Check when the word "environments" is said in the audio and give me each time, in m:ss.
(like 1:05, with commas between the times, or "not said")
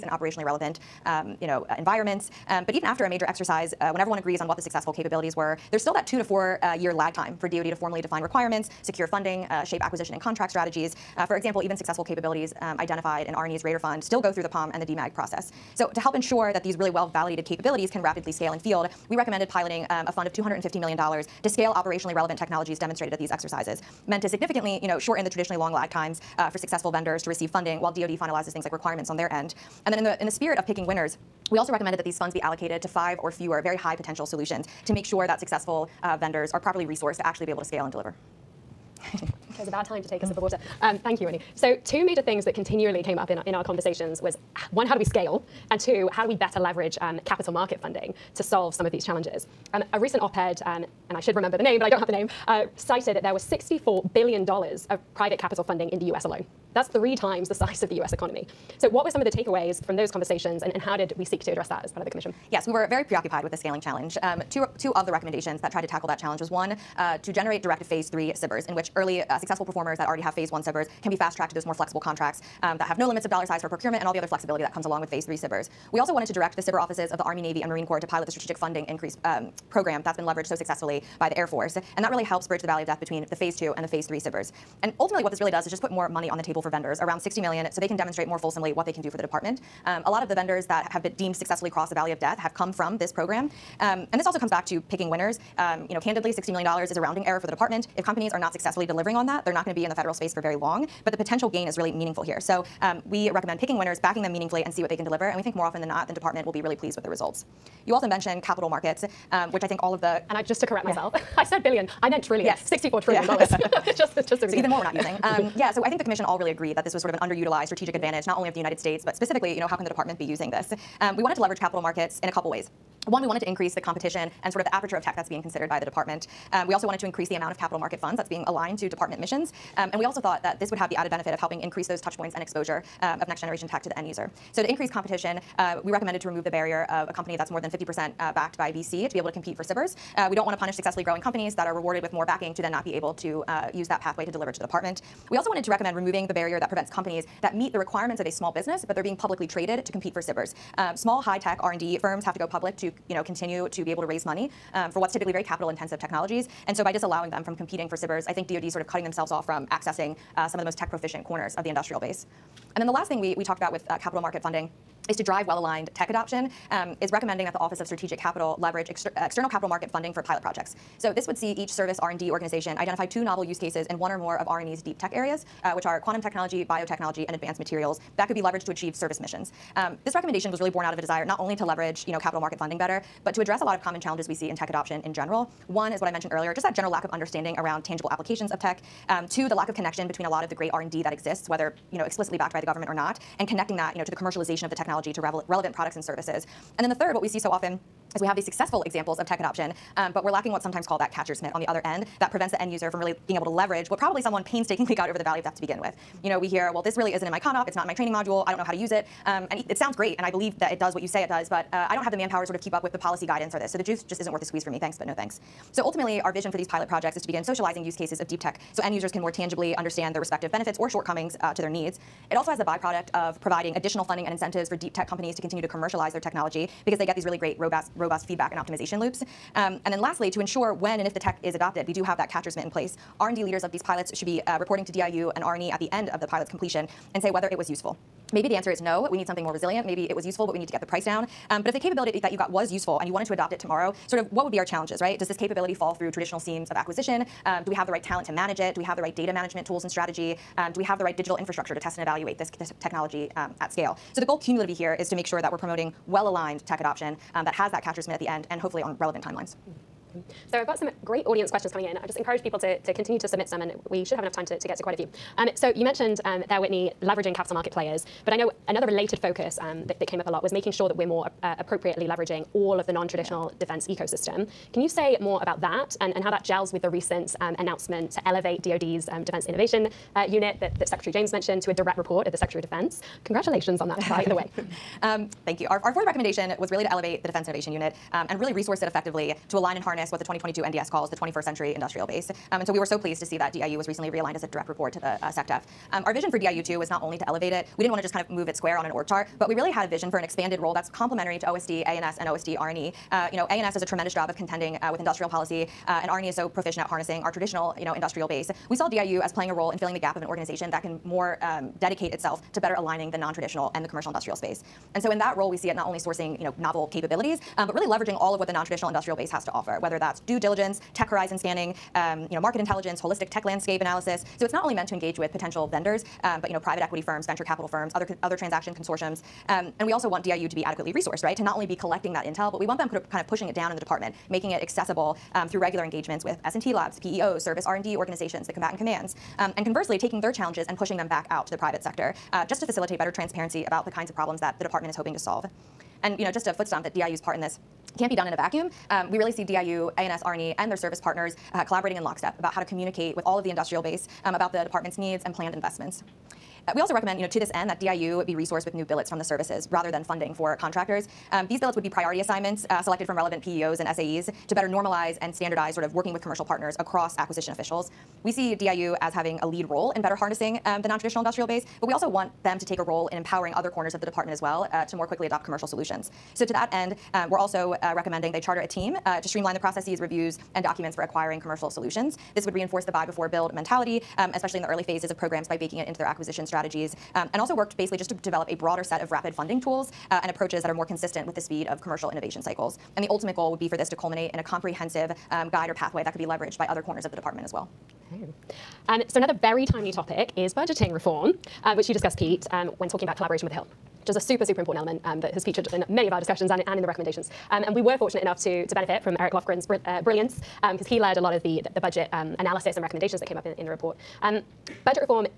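0:01.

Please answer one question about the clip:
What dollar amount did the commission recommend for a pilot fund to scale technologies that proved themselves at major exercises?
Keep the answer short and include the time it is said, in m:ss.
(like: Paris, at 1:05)
$250 million, at 0:20.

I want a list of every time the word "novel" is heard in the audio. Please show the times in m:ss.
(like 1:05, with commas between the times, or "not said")
2:53, 5:16.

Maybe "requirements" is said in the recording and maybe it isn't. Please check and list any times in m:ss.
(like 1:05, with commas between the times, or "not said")
0:08, 0:28, 2:27.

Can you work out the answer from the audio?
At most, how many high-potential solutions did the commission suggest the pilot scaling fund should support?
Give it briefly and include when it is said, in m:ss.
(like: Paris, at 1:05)
5, at 0:32.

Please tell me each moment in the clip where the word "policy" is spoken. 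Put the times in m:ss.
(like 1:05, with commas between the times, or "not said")
3:32, 5:05.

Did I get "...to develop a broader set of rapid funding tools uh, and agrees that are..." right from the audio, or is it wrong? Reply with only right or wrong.
wrong.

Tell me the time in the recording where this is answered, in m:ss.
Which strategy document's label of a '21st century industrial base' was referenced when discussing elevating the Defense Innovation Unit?
4:50.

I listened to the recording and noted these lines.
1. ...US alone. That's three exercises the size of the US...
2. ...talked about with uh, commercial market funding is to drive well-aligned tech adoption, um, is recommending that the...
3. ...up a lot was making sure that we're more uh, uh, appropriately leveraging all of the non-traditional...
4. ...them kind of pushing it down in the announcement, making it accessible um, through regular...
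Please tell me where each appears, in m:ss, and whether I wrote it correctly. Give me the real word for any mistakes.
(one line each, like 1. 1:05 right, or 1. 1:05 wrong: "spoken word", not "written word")
1. 0:56 wrong: "times", not "exercises"
2. 2:43 wrong: "capital", not "commercial"
3. 4:30 right
4. 5:32 wrong: "department", not "announcement".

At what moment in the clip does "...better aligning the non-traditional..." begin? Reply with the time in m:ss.
5:12.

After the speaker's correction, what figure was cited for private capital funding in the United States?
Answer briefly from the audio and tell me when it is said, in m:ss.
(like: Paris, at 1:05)
$64 trillion, at 1:52.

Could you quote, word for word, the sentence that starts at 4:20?
So I've got some great audience questions coming in.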